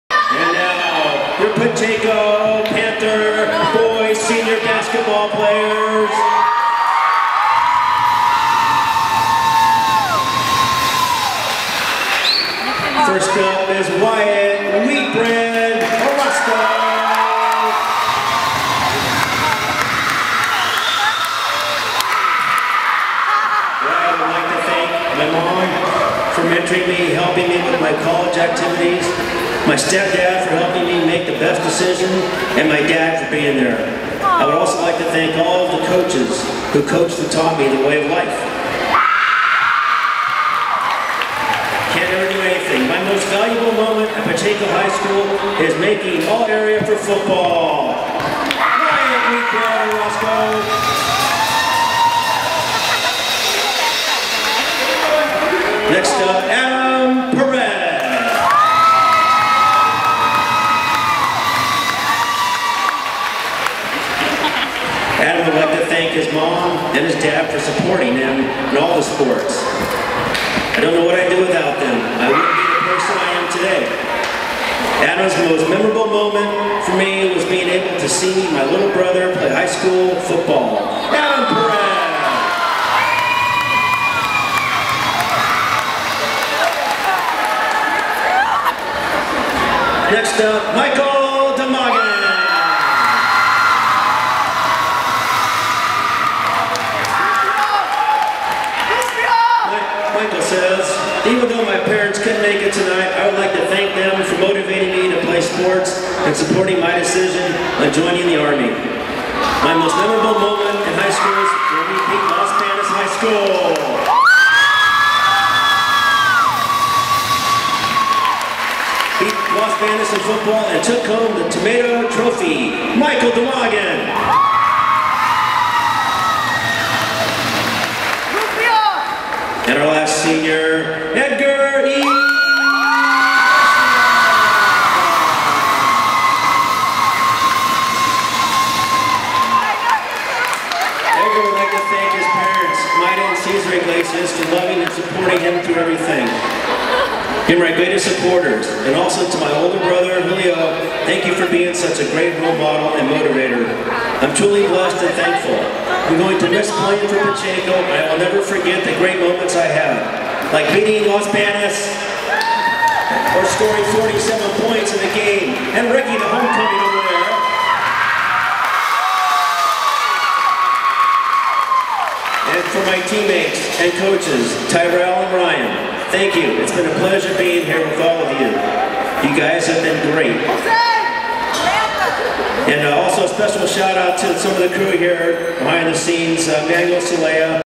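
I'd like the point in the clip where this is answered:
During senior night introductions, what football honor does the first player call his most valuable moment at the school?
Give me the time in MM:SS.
00:46.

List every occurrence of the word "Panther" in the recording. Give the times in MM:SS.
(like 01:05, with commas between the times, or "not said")
00:02.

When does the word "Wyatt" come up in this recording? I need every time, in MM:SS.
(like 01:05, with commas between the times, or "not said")
00:14, 00:23.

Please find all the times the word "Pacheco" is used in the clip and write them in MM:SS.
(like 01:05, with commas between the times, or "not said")
00:01, 00:44, 02:37.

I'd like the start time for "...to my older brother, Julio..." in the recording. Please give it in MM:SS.
02:29.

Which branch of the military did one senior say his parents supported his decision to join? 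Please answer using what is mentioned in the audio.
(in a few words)
Army.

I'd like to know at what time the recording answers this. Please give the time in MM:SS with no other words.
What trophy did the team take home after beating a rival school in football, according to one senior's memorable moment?
02:01.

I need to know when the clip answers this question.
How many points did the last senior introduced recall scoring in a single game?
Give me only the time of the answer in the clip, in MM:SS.
02:44.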